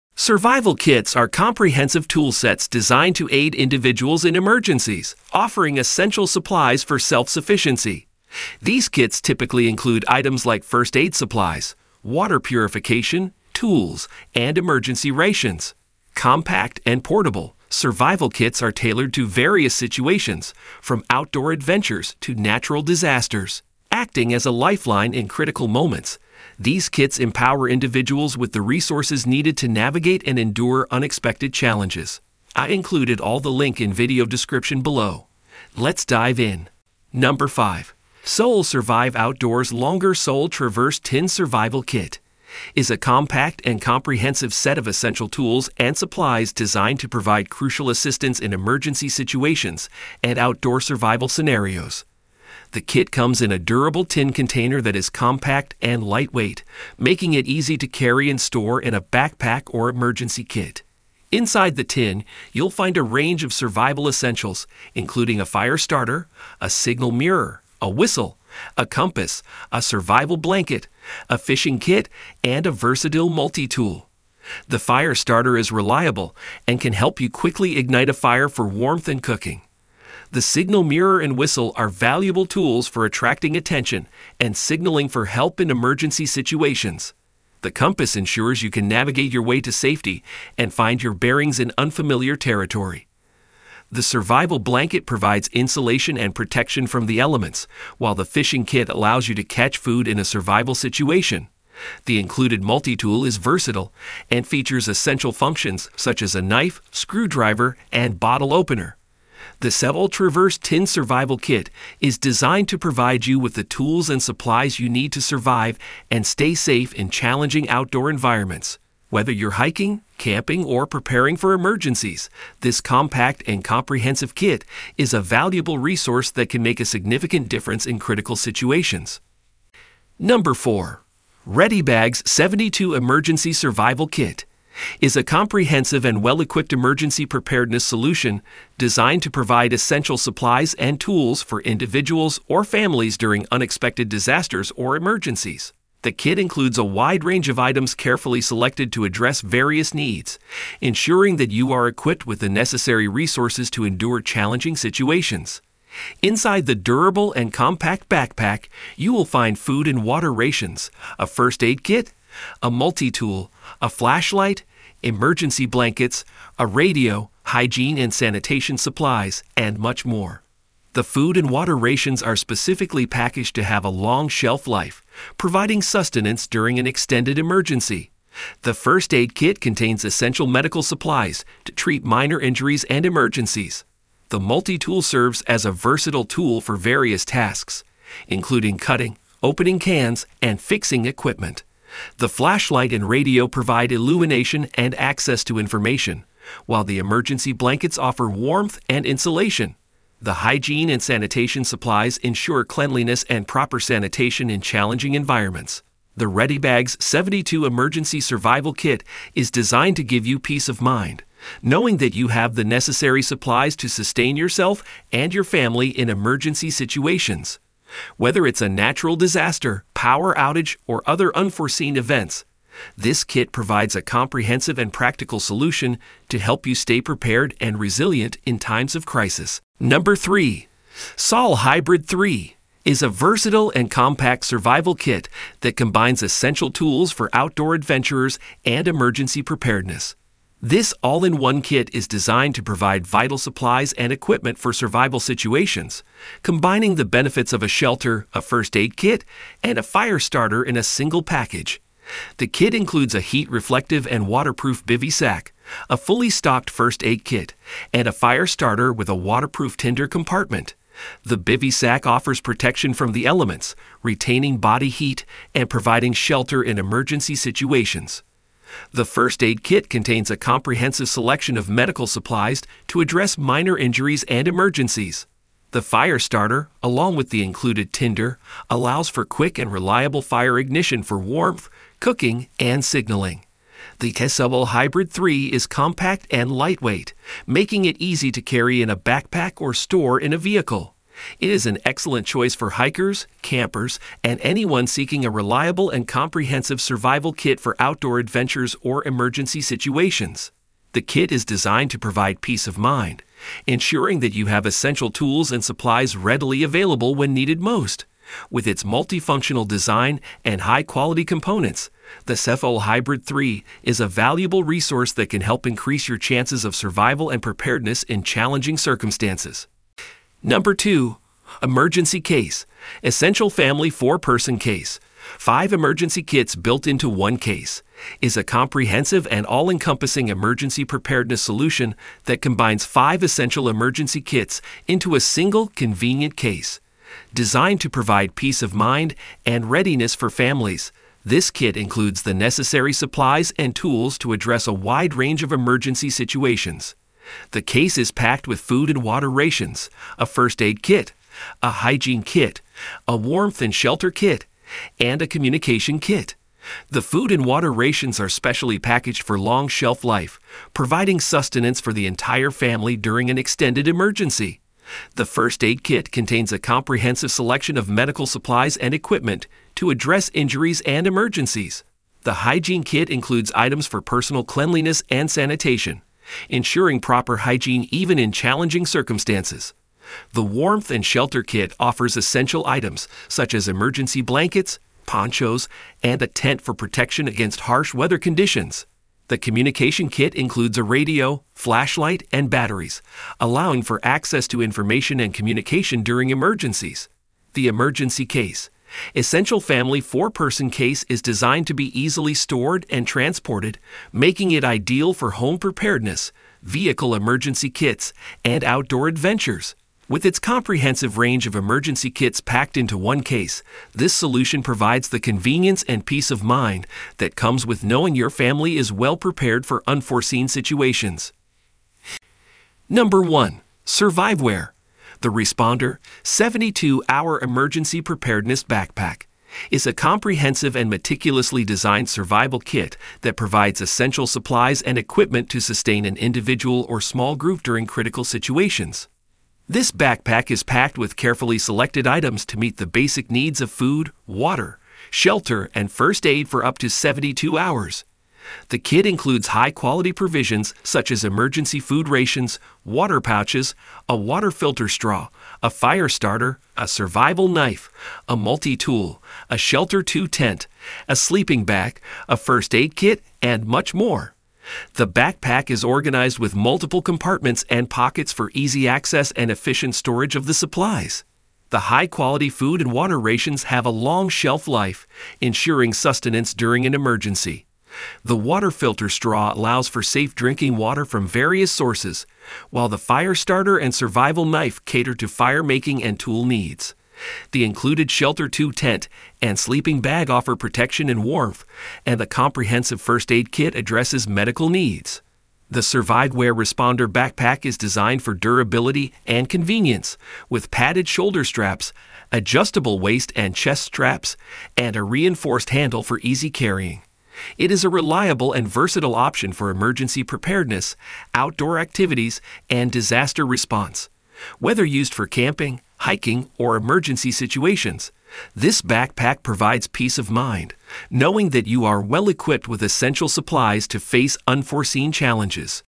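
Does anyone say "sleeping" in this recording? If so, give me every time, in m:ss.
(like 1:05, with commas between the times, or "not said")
7:41, 8:09.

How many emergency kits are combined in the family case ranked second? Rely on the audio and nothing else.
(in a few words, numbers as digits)
5.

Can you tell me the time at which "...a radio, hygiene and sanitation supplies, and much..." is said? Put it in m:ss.
2:46.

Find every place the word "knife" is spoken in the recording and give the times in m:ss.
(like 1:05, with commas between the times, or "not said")
1:46, 7:37, 8:04.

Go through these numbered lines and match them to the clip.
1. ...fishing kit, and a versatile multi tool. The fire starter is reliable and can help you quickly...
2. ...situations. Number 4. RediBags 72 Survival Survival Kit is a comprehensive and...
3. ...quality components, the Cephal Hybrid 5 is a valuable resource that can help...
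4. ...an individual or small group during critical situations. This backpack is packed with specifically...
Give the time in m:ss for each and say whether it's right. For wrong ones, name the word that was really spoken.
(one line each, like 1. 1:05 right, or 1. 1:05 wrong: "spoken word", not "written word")
1. 1:11 right
2. 2:08 wrong: "Emergency", not "Survival"
3. 5:10 wrong: "3", not "5"
4. 7:16 wrong: "carefully", not "specifically".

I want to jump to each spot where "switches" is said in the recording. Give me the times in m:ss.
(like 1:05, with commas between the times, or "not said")
not said.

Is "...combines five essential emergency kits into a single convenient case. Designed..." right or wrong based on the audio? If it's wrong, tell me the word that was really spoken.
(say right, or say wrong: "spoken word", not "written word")
right.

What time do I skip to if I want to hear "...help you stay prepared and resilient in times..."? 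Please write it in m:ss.
3:46.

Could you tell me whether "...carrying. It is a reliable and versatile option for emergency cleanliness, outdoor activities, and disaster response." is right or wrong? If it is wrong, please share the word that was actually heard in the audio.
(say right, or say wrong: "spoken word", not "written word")
wrong: "preparedness", not "cleanliness".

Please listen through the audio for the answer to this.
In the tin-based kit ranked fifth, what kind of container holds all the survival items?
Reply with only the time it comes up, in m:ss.
0:53.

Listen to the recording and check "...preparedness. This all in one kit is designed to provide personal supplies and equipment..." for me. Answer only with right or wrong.
wrong.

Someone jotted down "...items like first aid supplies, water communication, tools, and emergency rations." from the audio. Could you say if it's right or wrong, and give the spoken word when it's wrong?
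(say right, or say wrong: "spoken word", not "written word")
wrong: "purification", not "communication".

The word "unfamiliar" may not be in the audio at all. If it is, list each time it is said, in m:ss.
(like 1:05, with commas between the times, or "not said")
1:31.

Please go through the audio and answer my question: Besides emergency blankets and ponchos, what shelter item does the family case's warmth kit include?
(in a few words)
A tent.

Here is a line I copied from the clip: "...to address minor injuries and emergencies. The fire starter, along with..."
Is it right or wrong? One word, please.
right.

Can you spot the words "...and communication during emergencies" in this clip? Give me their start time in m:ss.
6:35.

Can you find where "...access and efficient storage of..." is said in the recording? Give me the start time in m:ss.
7:48.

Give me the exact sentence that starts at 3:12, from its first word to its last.
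The flashlight and radio provide illumination and access to information, while the emergency blankets offer warmth and insulation.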